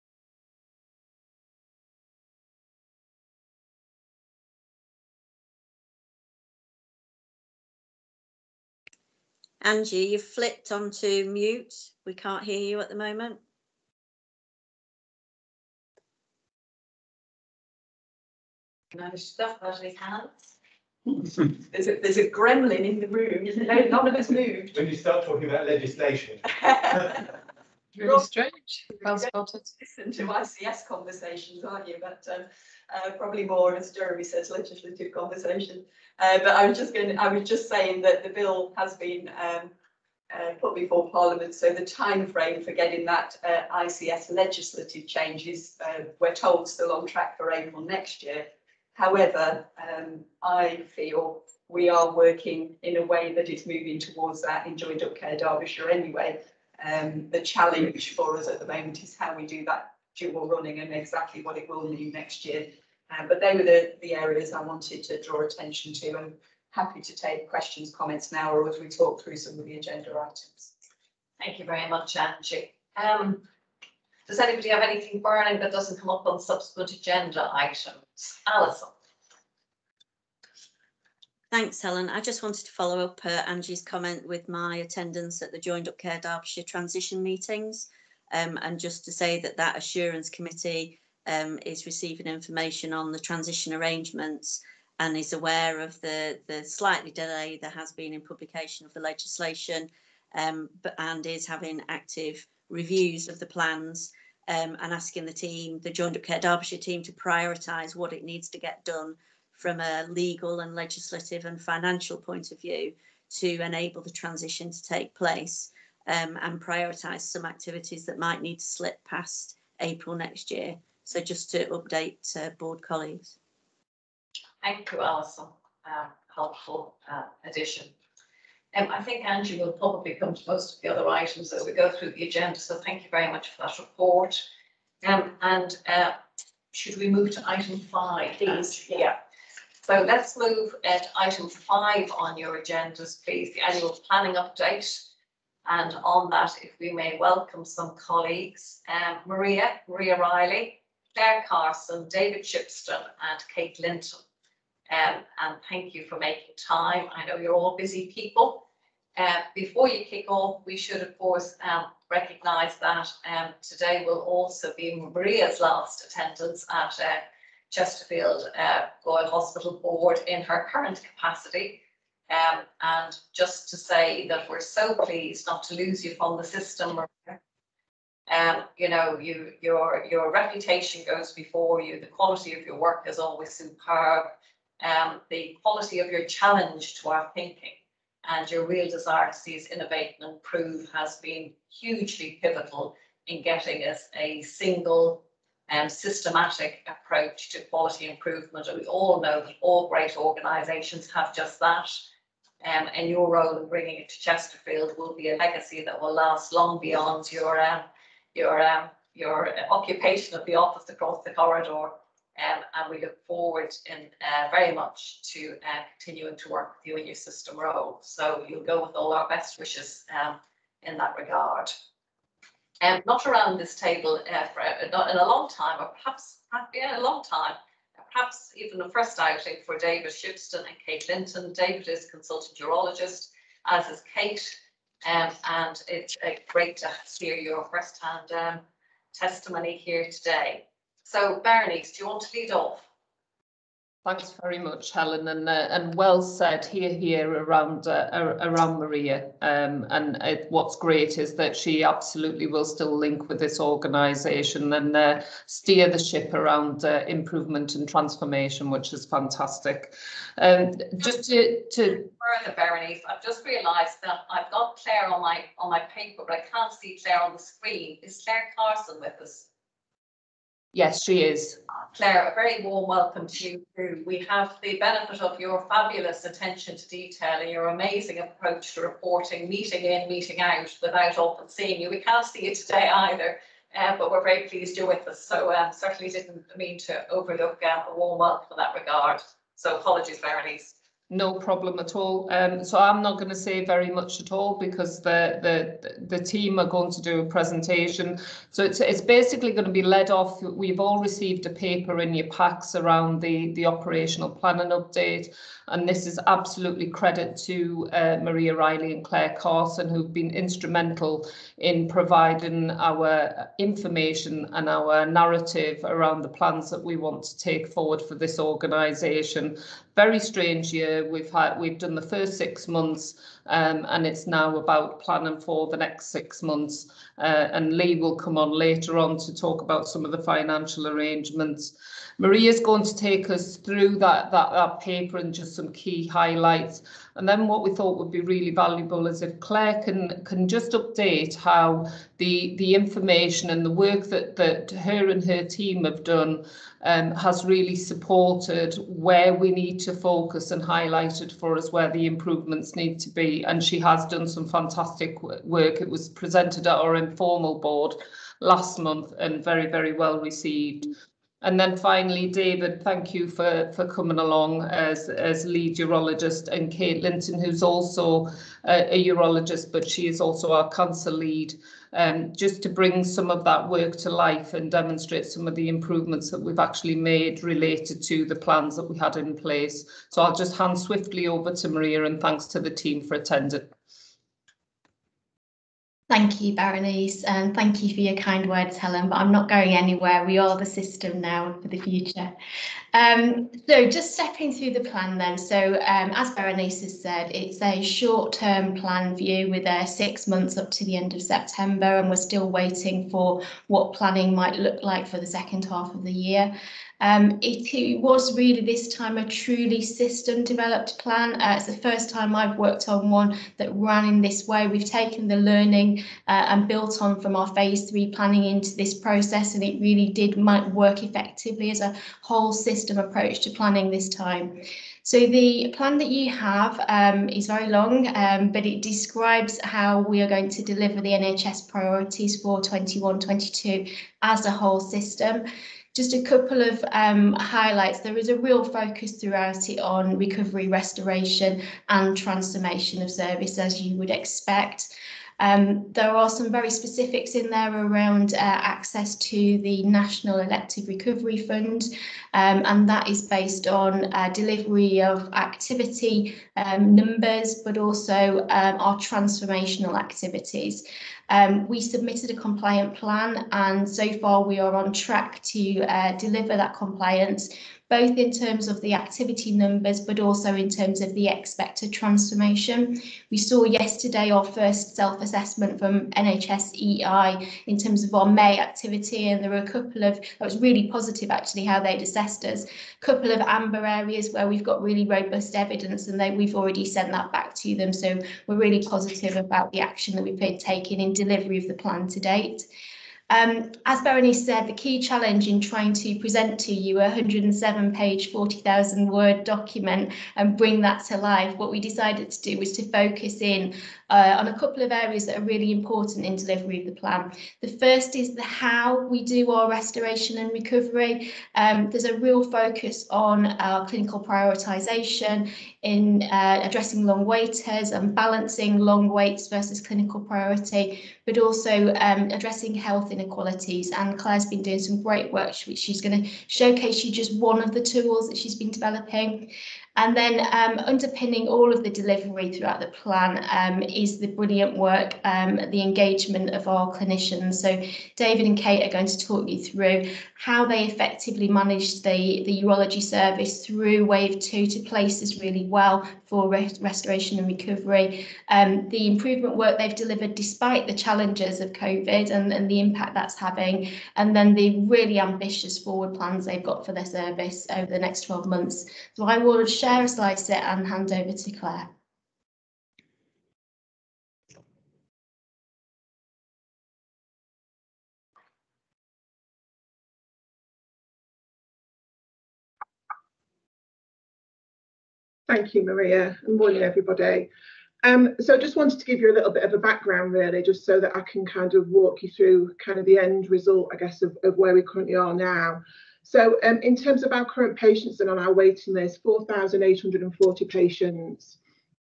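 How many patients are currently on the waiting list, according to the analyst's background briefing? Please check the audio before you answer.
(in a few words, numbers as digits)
4,840.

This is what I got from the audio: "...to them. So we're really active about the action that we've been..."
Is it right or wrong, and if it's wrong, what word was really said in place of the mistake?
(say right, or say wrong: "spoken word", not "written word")
wrong: "positive", not "active".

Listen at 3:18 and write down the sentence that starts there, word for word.
And we all know that all great organisations have just that.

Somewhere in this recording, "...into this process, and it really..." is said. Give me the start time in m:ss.
6:58.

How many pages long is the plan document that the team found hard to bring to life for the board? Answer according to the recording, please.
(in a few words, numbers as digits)
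107.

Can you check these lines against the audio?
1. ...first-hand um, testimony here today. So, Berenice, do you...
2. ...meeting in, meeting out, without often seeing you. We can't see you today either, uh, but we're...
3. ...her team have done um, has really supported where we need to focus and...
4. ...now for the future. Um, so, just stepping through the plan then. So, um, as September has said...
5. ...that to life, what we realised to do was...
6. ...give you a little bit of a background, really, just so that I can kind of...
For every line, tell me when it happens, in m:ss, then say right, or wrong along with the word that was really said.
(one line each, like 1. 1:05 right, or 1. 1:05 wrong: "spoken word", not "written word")
1. 3:57 right
2. 4:39 right
3. 5:45 right
4. 6:31 wrong: "Berenice", not "September"
5. 8:20 wrong: "decided", not "realised"
6. 9:39 right.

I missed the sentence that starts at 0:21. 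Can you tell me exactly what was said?
there's, a, there's a gremlin in the room.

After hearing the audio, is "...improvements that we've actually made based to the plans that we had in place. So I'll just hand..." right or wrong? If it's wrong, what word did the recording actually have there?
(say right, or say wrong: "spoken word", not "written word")
wrong: "related", not "based".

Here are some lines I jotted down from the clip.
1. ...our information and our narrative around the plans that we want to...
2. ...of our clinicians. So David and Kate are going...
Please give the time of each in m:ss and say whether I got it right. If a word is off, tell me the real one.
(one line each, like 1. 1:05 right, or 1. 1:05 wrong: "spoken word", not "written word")
1. 5:12 right
2. 8:56 right.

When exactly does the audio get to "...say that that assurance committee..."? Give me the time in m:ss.
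1:29.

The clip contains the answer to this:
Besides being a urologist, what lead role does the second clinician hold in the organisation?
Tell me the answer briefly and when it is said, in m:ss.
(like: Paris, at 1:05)
Cancer lead, at 6:10.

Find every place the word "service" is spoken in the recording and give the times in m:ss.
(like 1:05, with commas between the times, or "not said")
7:23, 9:03, 9:17.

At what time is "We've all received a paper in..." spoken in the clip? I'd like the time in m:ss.
5:00.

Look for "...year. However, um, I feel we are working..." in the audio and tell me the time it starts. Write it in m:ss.
0:48.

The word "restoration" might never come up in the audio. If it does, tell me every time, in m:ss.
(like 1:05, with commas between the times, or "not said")
7:20, 8:29, 9:06.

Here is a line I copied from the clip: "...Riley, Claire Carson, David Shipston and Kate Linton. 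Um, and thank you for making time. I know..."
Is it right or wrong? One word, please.
right.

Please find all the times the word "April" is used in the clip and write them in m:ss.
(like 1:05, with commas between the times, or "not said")
0:47, 1:59.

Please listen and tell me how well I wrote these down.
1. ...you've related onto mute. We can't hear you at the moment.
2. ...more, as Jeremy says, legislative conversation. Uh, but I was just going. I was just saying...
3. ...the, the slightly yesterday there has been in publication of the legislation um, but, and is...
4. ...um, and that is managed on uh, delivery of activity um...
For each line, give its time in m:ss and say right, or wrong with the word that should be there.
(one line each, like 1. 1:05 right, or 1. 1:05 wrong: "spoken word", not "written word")
1. 0:10 wrong: "flipped", not "related"
2. 0:33 right
3. 1:36 wrong: "delay", not "yesterday"
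4. 7:32 wrong: "based", not "managed".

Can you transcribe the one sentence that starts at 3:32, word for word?
Um, and we look forward in uh, very much to uh, continuing to work with you in your system role.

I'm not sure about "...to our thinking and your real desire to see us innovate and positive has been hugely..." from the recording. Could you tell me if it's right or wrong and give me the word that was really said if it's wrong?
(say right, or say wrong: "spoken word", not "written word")
wrong: "improve", not "positive".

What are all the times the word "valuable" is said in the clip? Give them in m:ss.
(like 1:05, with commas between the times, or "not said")
5:38.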